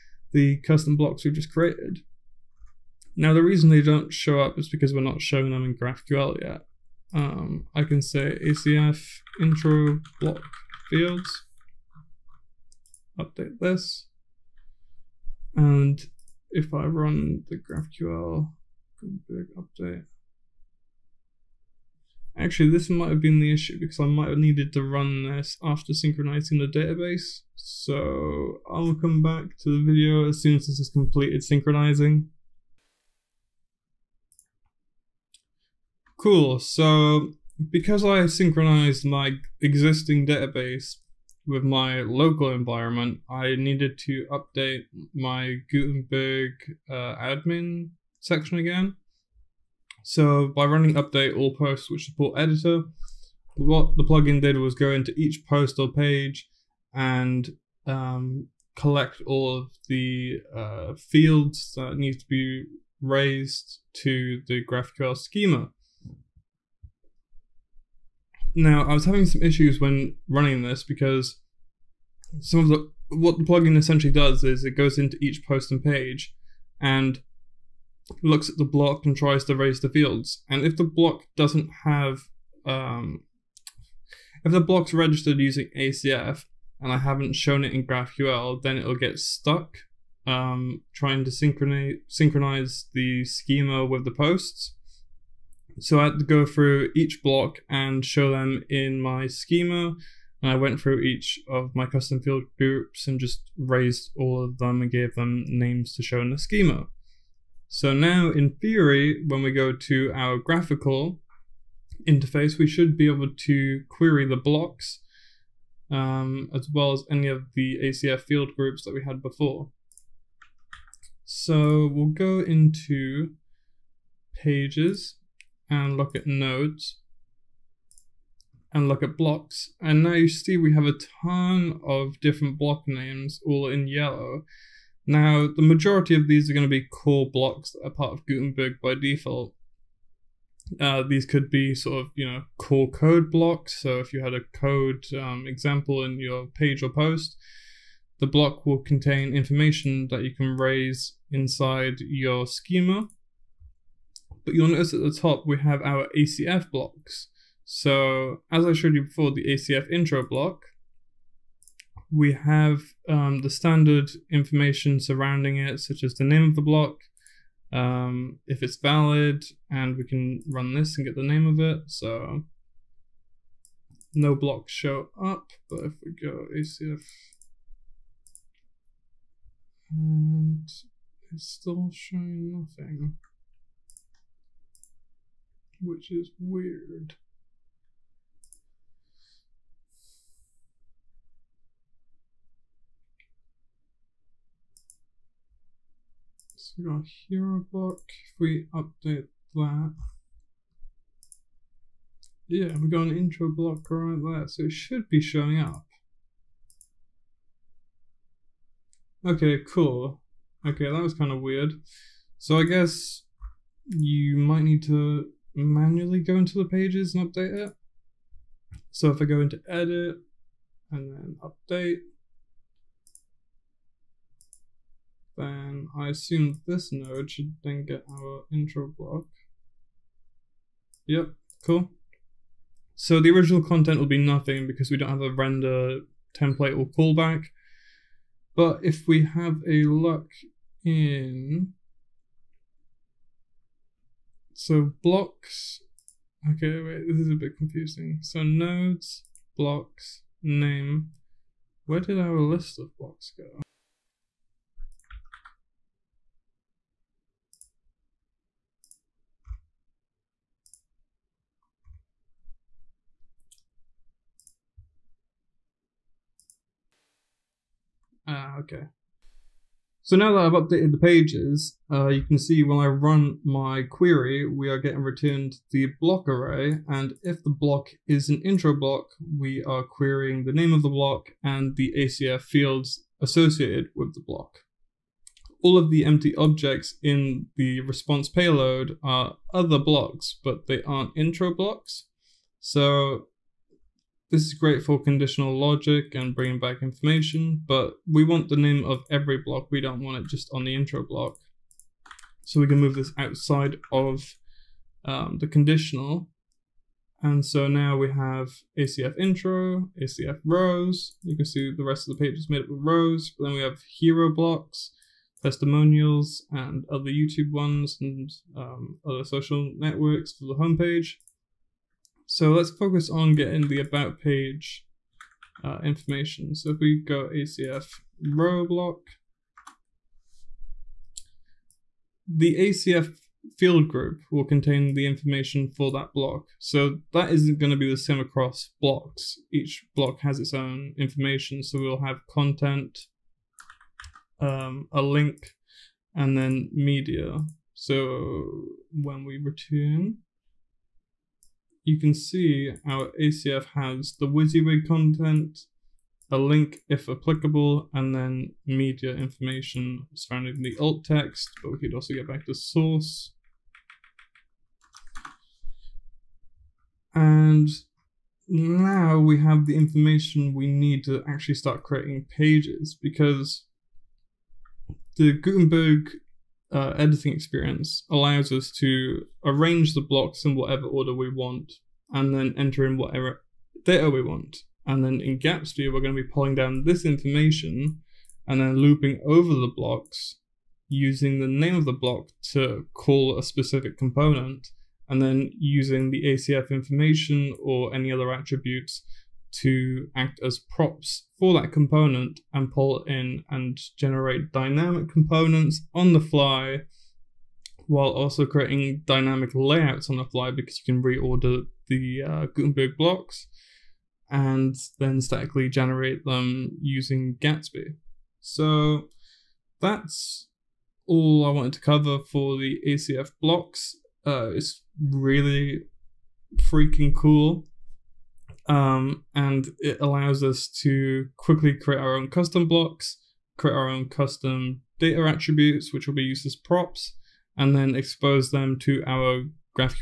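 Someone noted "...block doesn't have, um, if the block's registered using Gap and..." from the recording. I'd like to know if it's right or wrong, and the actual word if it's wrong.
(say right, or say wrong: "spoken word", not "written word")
wrong: "ACF", not "Gap".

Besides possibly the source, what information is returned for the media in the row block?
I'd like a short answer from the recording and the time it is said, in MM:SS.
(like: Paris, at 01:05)
Alt text, at 06:00.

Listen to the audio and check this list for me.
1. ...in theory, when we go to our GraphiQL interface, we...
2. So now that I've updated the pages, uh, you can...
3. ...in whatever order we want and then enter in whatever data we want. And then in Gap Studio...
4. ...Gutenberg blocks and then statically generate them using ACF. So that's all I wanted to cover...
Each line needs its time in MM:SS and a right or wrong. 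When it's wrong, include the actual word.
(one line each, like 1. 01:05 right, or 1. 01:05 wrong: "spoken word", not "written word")
1. 01:48 right
2. 04:30 right
3. 06:20 right
4. 06:52 wrong: "Gatsby", not "ACF".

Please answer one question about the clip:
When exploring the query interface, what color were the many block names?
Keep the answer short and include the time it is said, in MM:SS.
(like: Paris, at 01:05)
Yellow, at 02:13.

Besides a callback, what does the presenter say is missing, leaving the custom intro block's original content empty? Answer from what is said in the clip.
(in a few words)
A render template.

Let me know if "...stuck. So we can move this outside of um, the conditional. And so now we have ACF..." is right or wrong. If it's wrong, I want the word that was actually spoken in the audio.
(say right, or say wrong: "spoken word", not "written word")
wrong: "block", not "stuck".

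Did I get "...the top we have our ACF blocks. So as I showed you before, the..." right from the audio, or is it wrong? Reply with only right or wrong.
right.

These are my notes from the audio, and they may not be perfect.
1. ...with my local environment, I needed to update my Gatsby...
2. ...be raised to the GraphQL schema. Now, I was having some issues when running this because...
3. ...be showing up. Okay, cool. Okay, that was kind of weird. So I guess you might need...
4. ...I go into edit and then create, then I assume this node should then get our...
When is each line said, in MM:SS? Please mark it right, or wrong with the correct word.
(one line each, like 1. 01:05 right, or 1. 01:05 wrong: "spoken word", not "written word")
1. 00:41 wrong: "Gutenberg", not "Gatsby"
2. 01:02 right
3. 03:25 right
4. 03:39 wrong: "update", not "create".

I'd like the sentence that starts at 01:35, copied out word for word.
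So I had to go through each block and show them in my schema.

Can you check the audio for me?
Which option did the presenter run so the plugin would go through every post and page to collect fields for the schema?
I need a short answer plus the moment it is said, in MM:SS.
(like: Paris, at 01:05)
Update all posts which support editor, at 00:50.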